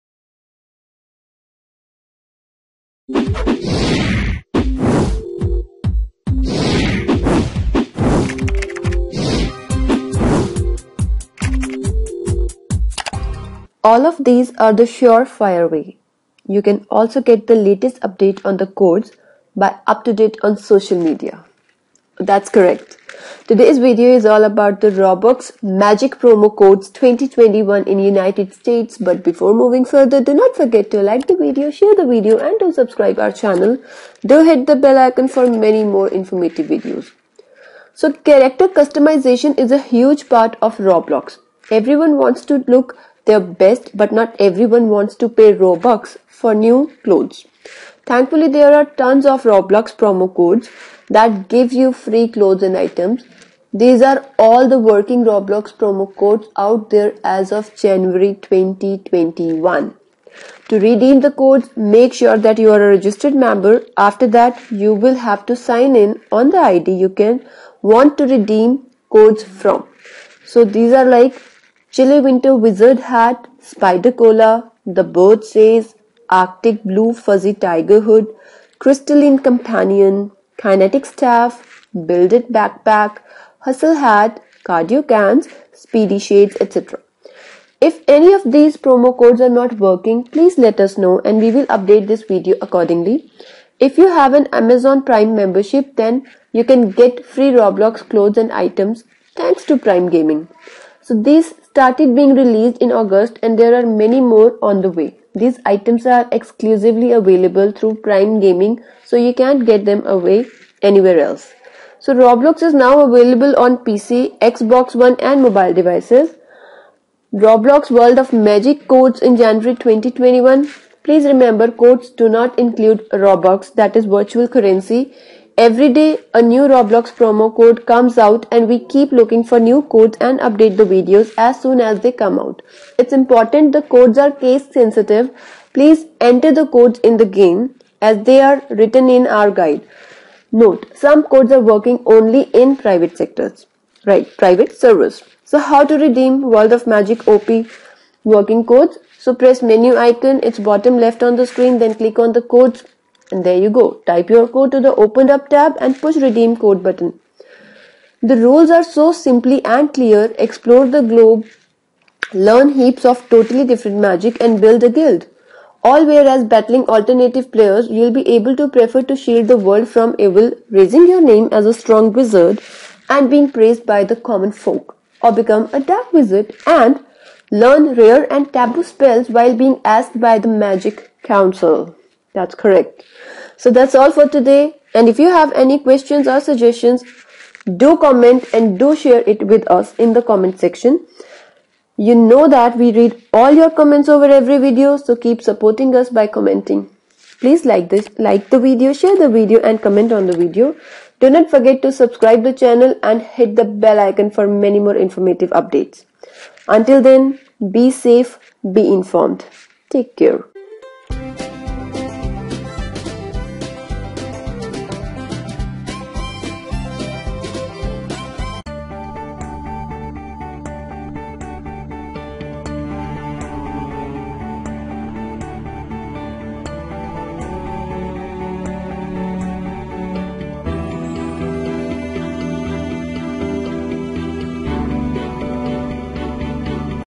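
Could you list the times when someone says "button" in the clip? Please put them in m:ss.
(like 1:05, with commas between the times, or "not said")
2:36.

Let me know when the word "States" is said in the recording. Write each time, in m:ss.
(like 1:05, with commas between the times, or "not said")
0:28.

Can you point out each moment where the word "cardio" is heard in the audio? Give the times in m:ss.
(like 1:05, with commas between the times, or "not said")
1:24.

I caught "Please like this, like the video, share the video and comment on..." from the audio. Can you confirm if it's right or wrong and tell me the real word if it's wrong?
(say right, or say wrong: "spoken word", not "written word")
right.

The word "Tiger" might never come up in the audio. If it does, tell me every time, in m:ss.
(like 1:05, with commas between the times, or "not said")
1:17.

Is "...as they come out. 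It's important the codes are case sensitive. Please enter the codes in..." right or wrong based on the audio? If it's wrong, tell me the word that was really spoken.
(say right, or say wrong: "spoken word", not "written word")
right.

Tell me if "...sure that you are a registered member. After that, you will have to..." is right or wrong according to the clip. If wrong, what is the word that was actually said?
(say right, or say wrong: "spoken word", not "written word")
right.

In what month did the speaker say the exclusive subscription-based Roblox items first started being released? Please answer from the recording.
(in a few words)
August.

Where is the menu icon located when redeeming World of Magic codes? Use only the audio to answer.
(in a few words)
Bottom left.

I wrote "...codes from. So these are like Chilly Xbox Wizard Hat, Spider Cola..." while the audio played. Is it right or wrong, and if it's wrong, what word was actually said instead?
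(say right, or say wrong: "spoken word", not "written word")
wrong: "Winter", not "Xbox".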